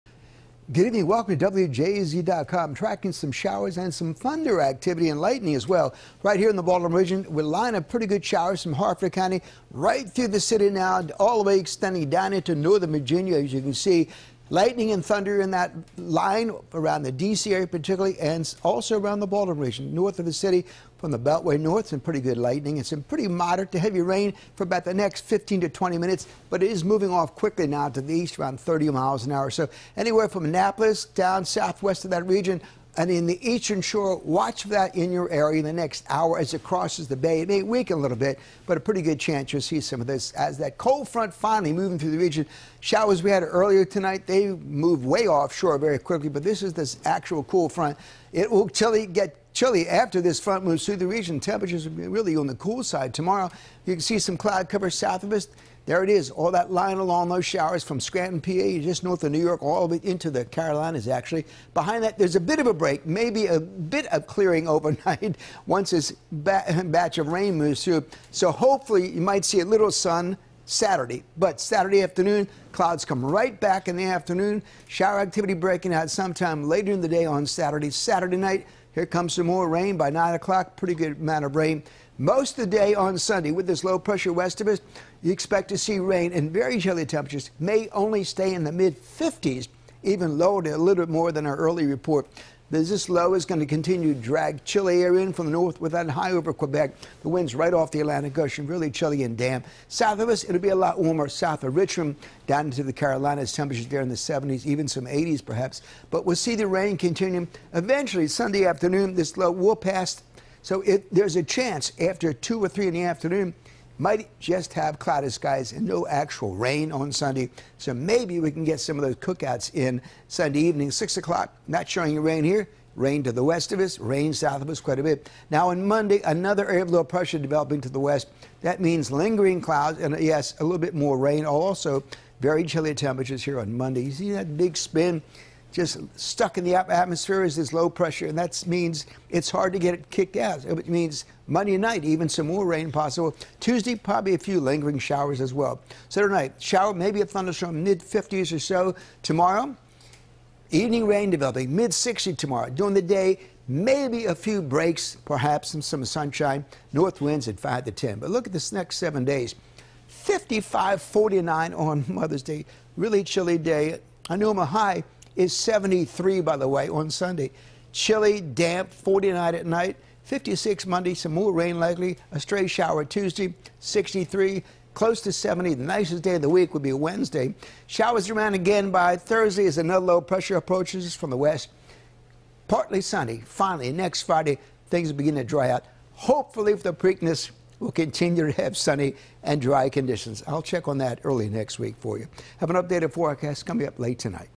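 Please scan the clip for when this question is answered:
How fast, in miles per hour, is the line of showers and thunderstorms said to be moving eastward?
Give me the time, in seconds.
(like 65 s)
28 s.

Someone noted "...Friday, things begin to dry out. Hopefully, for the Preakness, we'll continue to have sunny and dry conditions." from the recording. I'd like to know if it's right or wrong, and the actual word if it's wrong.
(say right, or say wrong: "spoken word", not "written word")
right.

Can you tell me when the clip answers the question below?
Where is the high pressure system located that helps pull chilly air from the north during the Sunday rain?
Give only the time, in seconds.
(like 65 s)
96 s.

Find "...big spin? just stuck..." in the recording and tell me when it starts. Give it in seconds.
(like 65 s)
134 s.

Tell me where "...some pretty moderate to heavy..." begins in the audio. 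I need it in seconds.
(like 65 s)
22 s.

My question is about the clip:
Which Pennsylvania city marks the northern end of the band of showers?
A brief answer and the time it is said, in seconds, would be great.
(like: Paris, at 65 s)
Scranton, at 57 s.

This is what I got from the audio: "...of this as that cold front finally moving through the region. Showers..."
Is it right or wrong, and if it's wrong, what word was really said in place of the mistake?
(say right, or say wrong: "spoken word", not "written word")
right.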